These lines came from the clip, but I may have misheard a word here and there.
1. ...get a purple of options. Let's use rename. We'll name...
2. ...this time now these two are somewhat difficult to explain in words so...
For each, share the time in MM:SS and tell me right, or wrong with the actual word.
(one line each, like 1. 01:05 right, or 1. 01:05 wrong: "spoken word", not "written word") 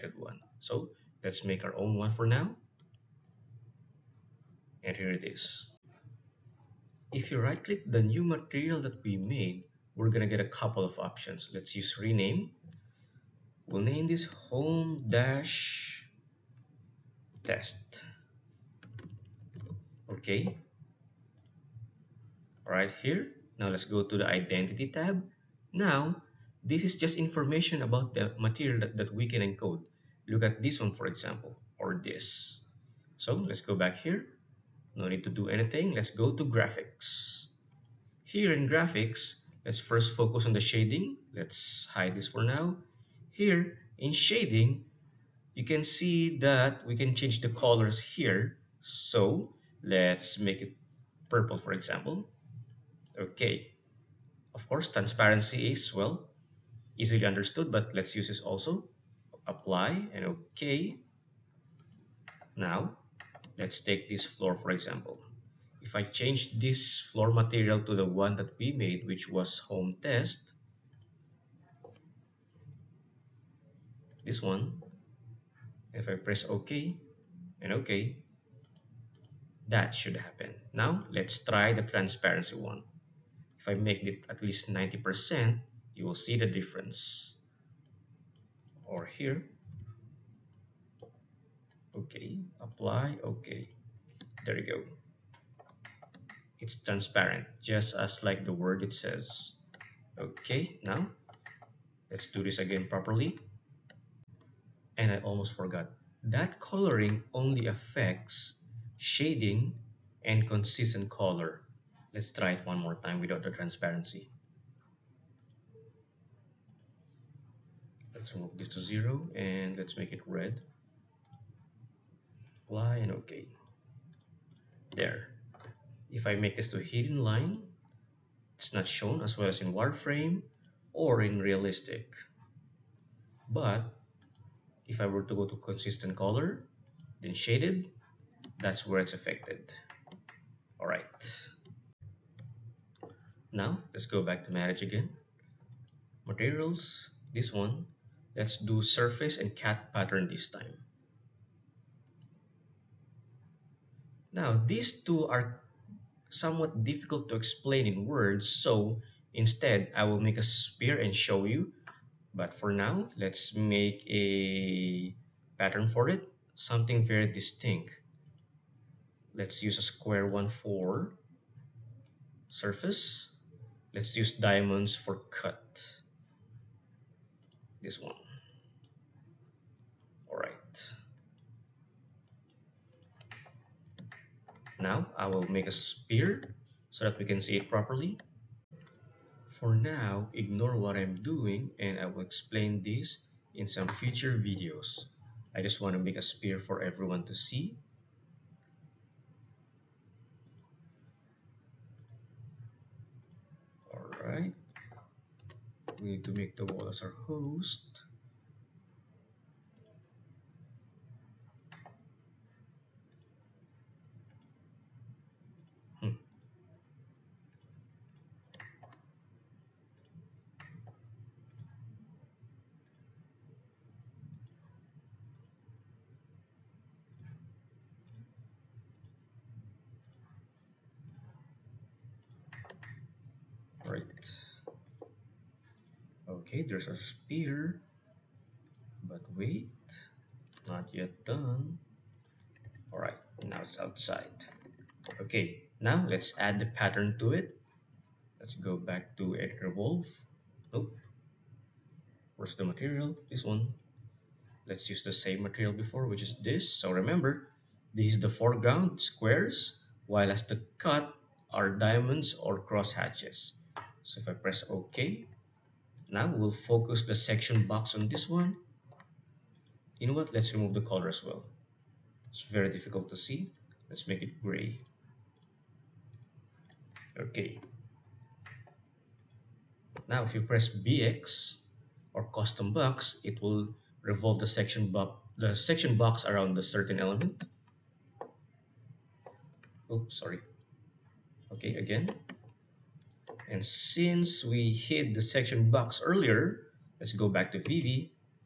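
1. 00:10 wrong: "couple", not "purple"
2. 02:30 right.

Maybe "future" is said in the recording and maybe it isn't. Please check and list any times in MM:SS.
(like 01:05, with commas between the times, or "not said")
03:13.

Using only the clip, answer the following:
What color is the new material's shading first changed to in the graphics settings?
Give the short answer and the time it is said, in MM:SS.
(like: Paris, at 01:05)
purple, at 00:51.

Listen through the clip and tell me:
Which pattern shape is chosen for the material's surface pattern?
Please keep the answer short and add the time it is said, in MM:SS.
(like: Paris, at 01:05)
square, at 02:49.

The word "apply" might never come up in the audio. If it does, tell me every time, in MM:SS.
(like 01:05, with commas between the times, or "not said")
00:59, 01:32, 02:02.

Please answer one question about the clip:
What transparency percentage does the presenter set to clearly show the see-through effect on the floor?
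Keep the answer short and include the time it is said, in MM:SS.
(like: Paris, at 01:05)
90%, at 01:24.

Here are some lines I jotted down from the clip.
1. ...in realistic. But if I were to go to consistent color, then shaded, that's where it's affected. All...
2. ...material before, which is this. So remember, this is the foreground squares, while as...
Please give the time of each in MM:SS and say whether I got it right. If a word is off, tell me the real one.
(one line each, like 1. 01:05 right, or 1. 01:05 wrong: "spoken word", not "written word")
1. 02:11 right
2. 04:15 right.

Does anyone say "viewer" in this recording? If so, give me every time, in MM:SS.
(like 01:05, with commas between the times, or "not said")
not said.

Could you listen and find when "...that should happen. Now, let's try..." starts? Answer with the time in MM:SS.
01:19.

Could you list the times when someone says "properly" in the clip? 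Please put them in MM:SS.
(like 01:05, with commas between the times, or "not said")
01:42, 03:07.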